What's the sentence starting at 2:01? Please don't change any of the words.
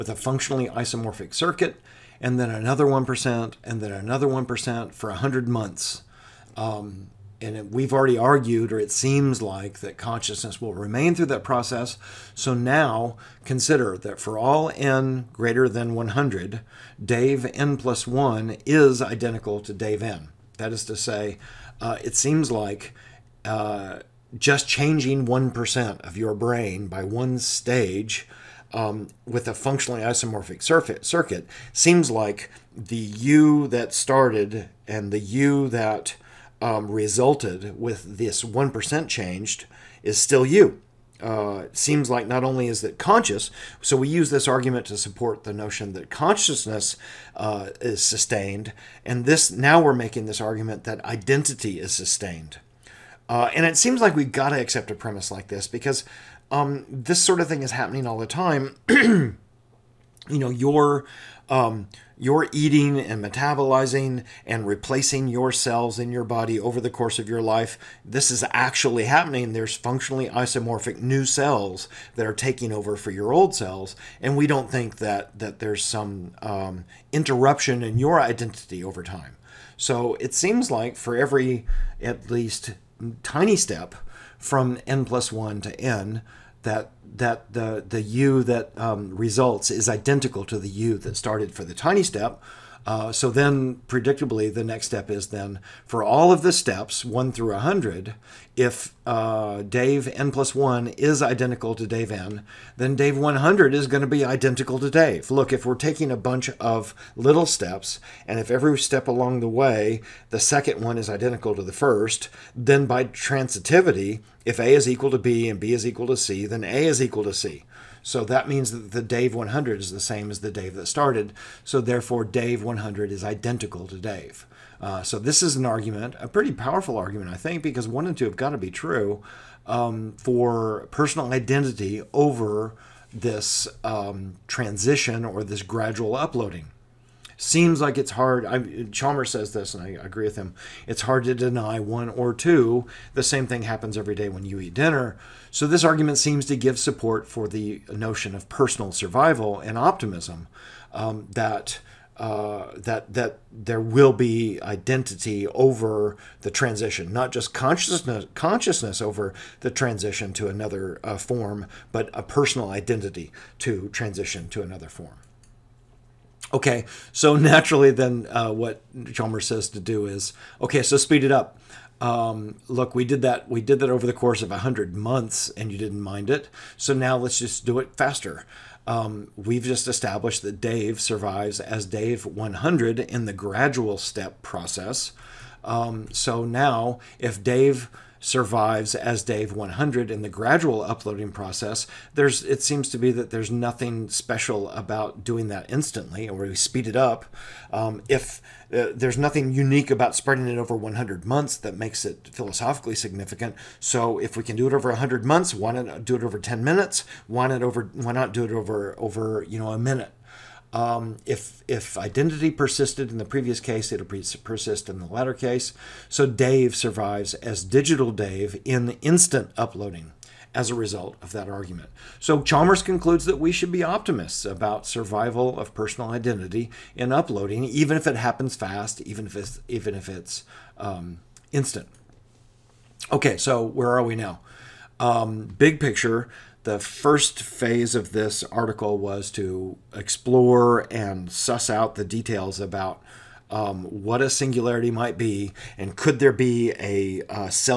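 So therefore, Dave 100 is identical to Dave.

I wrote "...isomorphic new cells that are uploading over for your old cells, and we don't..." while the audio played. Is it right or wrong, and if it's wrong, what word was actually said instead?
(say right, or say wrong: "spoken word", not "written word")
wrong: "taking", not "uploading".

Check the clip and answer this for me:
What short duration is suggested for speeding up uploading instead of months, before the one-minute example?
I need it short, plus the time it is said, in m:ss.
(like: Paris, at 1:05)
10 minutes, at 3:26.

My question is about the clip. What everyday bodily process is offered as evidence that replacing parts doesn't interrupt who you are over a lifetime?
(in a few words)
Eating and metabolizing.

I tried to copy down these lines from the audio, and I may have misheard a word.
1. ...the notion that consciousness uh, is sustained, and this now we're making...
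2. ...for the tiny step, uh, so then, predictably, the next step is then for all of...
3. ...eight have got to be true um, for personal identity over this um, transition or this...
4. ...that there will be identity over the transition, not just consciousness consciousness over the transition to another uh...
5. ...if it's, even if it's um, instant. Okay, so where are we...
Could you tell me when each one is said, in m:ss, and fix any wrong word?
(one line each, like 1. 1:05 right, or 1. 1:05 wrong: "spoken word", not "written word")
1. 0:45 right
2. 1:31 right
3. 2:08 wrong: "two", not "eight"
4. 2:33 right
5. 3:49 right.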